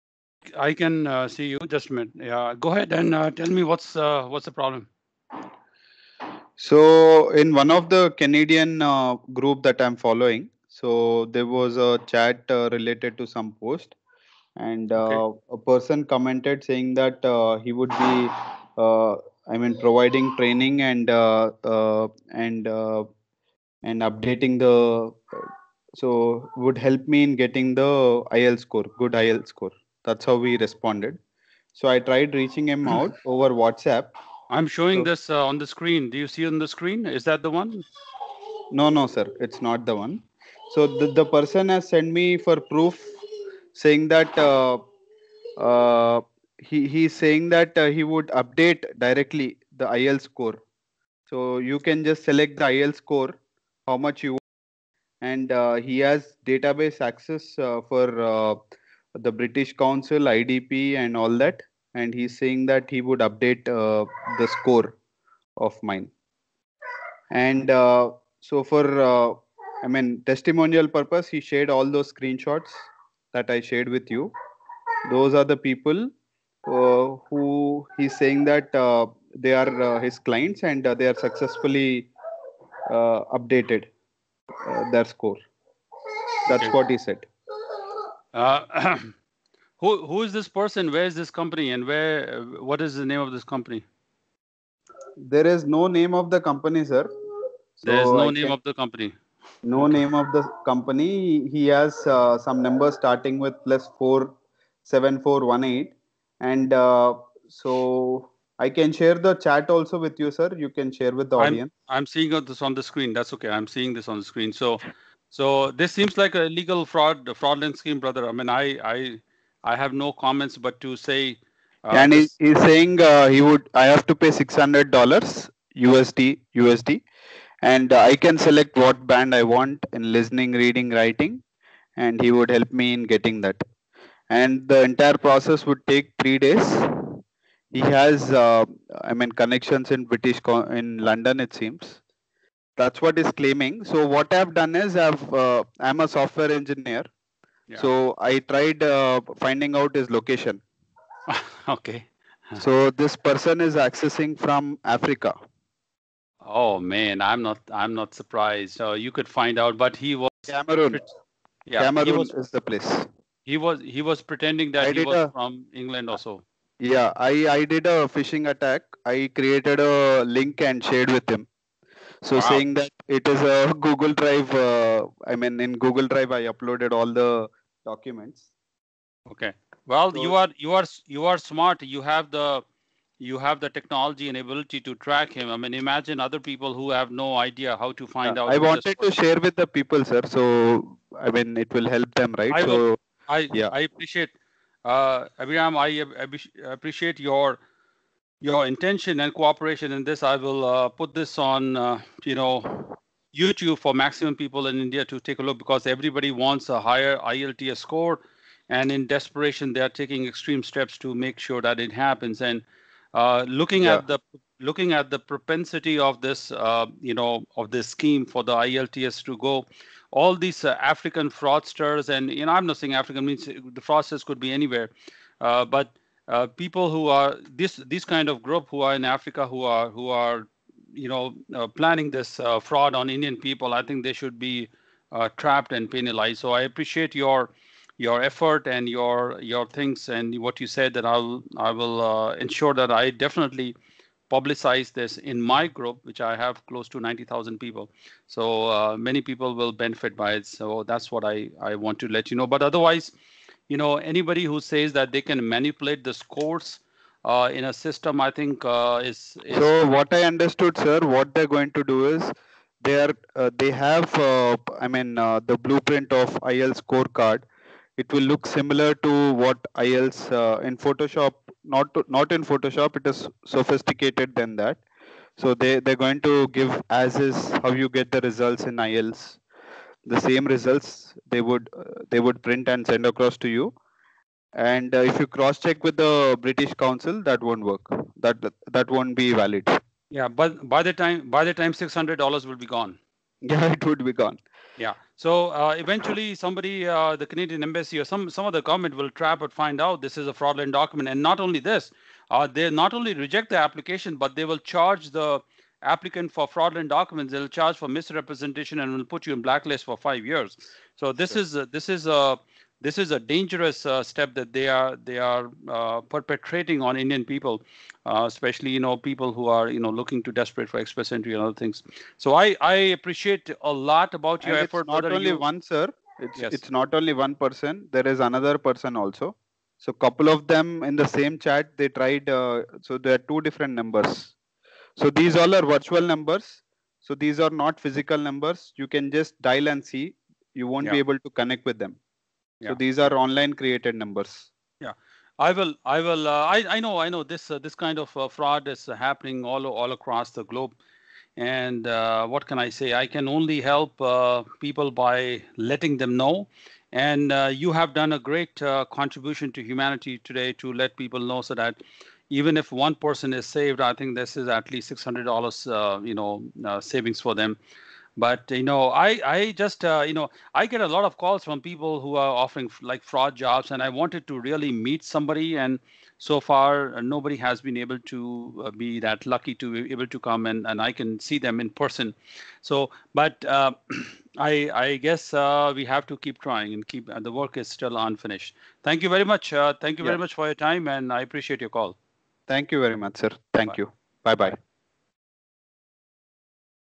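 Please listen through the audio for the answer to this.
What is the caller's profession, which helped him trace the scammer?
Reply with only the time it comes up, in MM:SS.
02:26.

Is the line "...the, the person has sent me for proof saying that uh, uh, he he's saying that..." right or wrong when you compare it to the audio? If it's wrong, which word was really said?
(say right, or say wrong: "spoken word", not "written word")
right.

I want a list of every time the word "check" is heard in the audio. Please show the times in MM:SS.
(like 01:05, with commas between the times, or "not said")
04:45.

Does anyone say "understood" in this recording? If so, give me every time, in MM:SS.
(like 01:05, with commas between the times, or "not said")
04:20.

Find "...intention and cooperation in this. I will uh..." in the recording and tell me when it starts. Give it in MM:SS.
03:18.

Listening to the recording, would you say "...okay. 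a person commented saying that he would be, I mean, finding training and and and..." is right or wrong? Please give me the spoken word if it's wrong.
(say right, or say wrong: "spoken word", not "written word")
wrong: "providing", not "finding".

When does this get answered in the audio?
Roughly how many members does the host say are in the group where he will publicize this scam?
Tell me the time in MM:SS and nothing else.
04:07.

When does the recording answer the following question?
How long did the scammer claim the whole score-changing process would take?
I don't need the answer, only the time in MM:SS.
02:16.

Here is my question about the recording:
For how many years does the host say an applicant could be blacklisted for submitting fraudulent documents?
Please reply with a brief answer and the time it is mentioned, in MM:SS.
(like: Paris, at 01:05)
5 years, at 05:09.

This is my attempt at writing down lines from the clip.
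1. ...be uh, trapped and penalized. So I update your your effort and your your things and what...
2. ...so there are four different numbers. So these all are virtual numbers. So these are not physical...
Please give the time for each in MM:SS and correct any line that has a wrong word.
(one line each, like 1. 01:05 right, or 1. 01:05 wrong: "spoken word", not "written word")
1. 03:54 wrong: "appreciate", not "update"
2. 05:32 wrong: "two", not "four".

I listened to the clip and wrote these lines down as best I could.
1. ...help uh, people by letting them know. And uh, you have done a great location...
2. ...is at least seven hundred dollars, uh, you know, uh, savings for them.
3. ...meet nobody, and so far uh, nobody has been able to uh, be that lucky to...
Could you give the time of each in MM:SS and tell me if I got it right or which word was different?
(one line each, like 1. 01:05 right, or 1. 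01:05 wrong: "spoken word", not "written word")
1. 05:53 wrong: "contribution", not "location"
2. 06:04 wrong: "six", not "seven"
3. 06:14 wrong: "somebody", not "nobody".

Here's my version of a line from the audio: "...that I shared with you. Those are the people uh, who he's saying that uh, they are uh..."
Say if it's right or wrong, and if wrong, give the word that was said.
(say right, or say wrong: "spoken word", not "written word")
right.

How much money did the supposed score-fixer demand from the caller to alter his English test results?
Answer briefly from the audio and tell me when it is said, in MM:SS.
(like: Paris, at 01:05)
600 US dollars, at 02:04.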